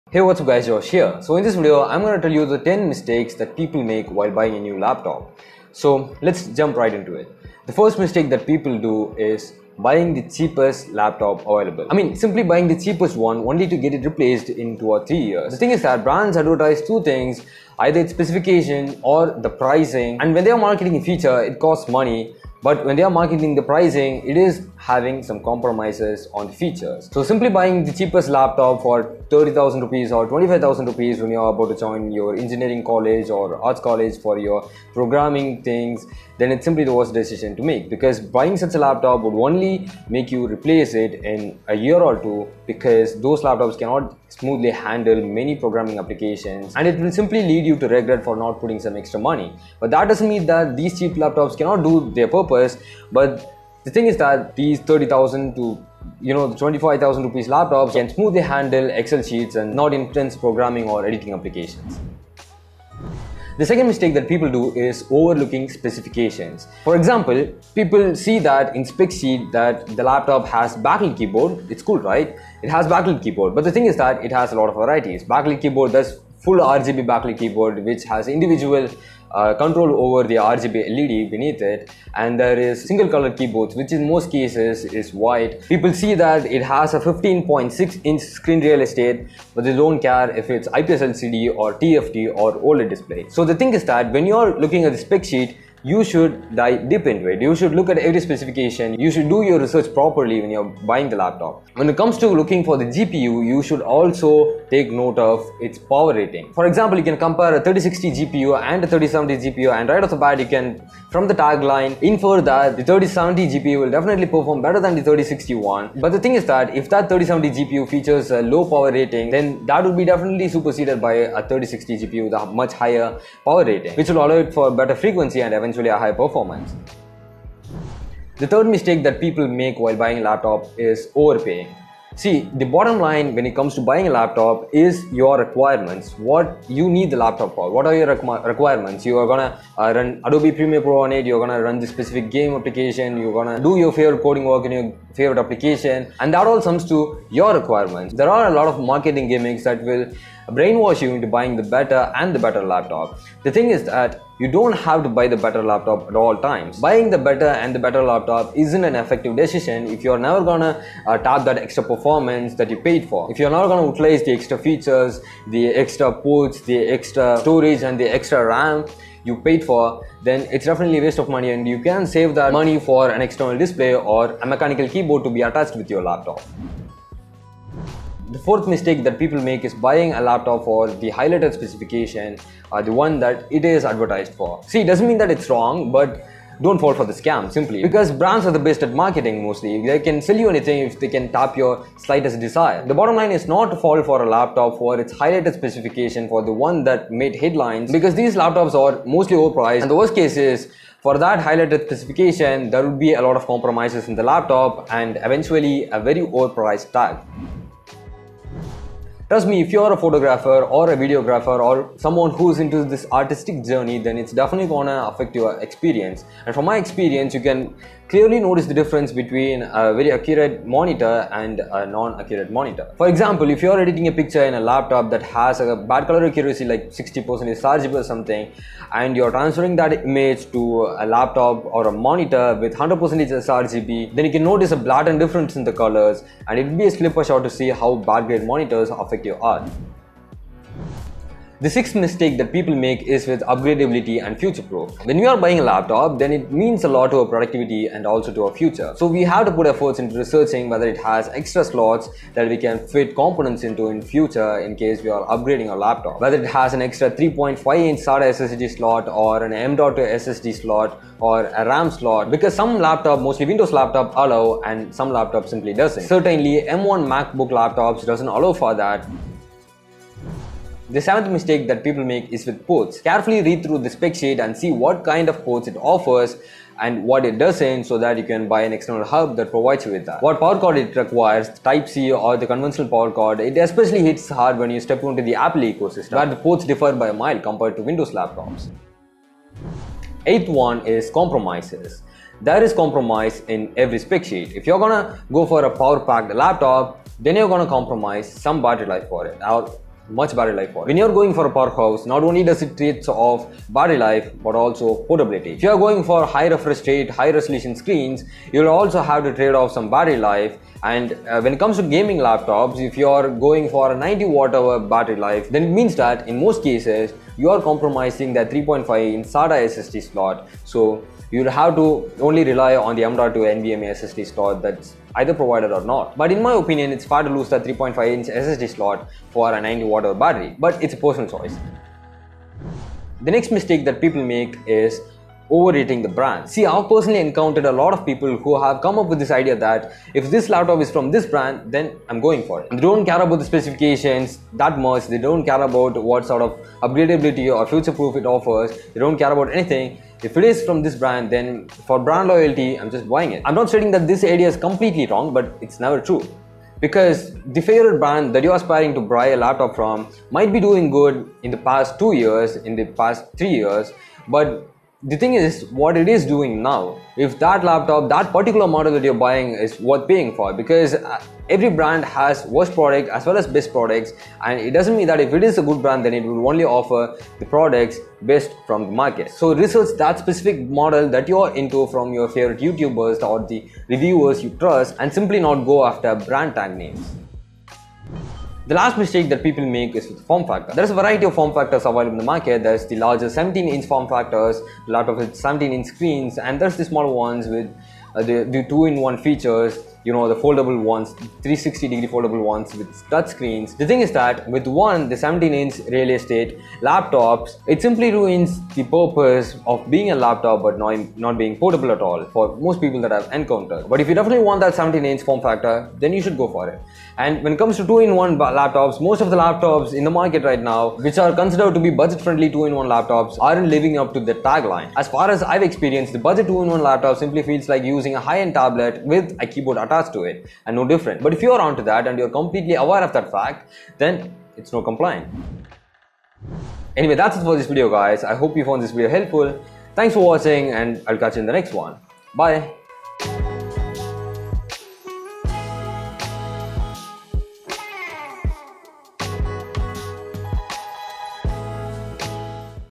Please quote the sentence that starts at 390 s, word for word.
There's a variety of form factors available in the market.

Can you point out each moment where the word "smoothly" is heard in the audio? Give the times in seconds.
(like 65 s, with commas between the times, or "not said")
44 s, 58 s.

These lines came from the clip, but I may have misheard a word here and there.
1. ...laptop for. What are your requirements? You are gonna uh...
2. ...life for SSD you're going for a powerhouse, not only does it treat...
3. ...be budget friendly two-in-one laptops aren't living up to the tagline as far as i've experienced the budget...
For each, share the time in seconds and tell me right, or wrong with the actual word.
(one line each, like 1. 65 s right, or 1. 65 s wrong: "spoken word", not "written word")
1. 137 s right
2. 300 s wrong: "When", not "SSD"
3. 421 s right.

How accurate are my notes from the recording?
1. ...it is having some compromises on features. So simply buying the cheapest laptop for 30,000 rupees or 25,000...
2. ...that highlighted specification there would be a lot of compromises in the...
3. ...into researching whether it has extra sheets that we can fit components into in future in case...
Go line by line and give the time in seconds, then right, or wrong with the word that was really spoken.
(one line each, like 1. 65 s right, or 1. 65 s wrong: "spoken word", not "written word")
1. 24 s right
2. 201 s right
3. 249 s wrong: "slots", not "sheets".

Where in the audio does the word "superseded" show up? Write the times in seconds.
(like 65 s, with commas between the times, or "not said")
120 s.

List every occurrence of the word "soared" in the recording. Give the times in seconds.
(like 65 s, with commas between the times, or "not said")
not said.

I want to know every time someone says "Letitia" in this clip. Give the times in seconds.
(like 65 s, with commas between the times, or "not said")
not said.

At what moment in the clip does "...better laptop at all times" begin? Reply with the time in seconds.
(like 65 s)
155 s.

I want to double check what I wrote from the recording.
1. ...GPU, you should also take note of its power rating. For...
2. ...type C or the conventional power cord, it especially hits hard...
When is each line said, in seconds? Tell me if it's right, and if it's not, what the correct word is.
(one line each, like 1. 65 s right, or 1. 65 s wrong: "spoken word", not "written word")
1. 102 s right
2. 281 s right.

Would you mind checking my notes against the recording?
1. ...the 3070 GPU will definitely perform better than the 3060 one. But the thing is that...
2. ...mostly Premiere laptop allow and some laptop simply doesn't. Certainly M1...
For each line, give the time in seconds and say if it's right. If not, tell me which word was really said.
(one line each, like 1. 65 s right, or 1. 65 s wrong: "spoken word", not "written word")
1. 112 s right
2. 263 s wrong: "Windows", not "Premiere".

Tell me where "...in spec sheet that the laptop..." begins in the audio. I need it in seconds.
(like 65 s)
68 s.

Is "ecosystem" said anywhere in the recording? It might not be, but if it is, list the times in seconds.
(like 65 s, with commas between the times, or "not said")
285 s.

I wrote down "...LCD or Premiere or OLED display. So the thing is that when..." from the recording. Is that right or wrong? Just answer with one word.
wrong.